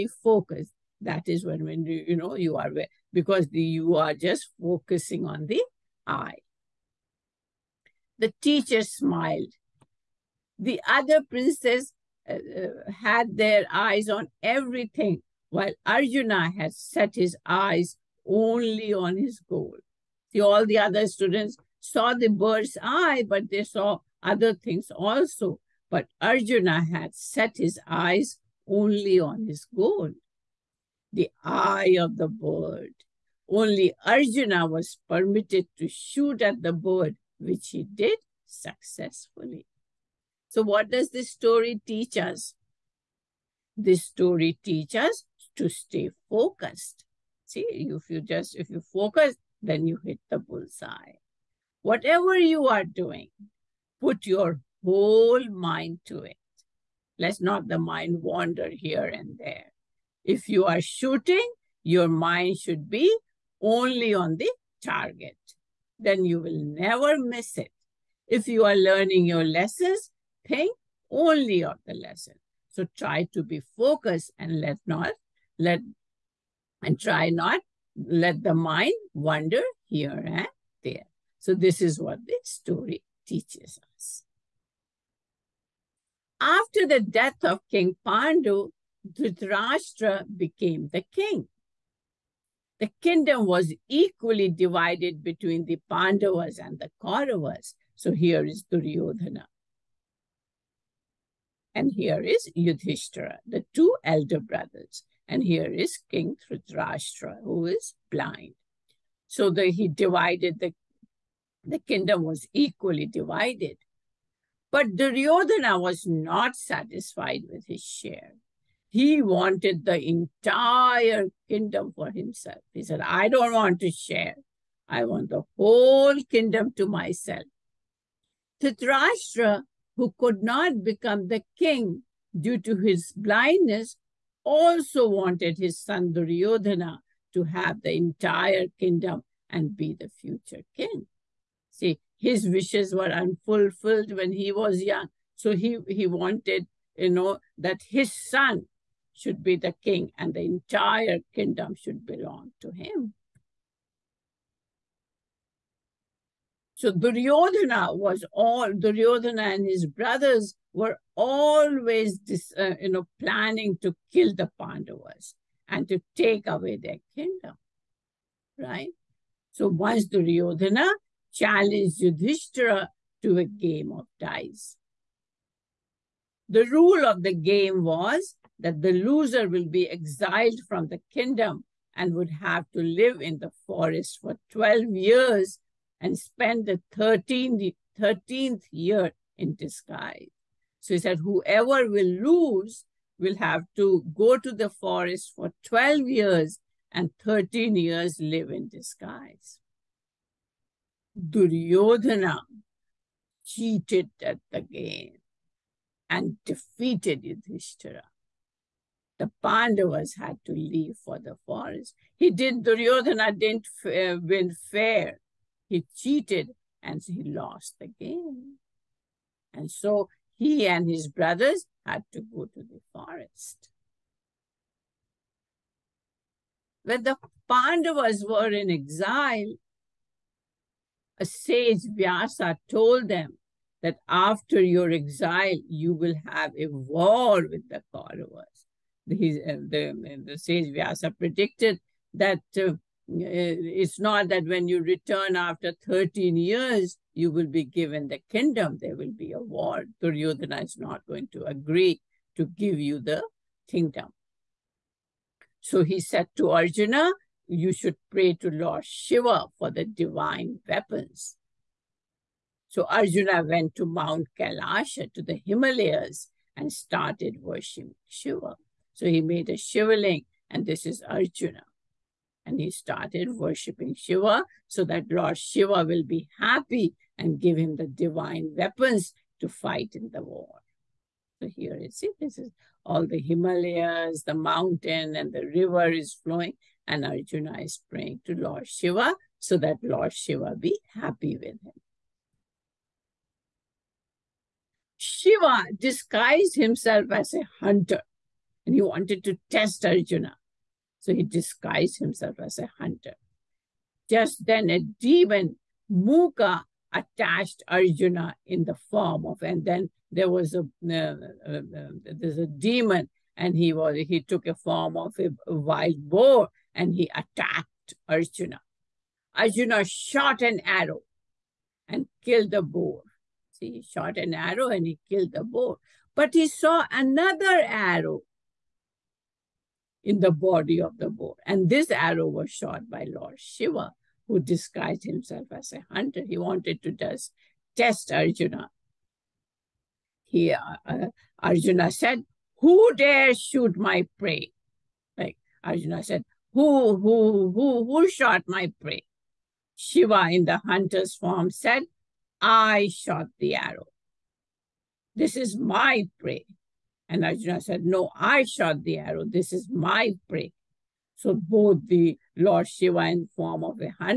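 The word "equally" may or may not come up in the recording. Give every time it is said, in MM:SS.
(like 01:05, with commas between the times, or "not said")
01:33, 01:52.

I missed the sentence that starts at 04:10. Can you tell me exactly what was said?
Duryodhana is not going to agree to give you the kingdom.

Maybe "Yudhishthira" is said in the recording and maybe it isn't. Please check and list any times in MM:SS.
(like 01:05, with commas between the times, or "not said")
01:42, 02:51, 03:27.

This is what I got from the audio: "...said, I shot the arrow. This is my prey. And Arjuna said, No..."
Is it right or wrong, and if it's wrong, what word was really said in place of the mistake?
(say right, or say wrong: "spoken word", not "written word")
right.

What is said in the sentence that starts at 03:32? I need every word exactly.
He did, Duryodhana didn't uh, win fair.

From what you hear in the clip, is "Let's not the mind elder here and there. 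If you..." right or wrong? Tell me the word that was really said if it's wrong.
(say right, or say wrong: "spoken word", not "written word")
wrong: "wander", not "elder".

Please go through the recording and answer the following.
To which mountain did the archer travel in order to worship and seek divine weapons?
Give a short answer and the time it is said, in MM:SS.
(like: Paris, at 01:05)
Mount Kailasha, at 04:23.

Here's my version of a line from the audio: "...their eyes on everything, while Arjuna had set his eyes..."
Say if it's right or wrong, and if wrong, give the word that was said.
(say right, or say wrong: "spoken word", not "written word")
right.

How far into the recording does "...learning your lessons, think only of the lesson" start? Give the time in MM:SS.
01:08.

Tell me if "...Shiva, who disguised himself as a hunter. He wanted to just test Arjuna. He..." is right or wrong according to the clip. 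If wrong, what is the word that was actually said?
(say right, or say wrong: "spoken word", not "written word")
right.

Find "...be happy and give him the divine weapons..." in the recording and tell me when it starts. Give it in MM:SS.
04:36.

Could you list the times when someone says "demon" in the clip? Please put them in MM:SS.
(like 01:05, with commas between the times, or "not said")
05:04, 05:12.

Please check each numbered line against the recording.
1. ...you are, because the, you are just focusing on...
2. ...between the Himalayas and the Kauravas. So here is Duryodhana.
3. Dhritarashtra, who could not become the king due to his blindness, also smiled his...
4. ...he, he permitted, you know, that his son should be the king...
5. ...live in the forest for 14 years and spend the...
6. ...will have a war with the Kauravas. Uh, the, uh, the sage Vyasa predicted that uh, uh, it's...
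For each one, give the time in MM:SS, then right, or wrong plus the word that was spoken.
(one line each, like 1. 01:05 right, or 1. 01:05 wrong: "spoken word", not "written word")
1. 00:02 right
2. 01:35 wrong: "Pandavas", not "Himalayas"
3. 02:08 wrong: "wanted", not "smiled"
4. 02:25 wrong: "wanted", not "permitted"
5. 03:02 wrong: "12", not "14"
6. 03:55 right.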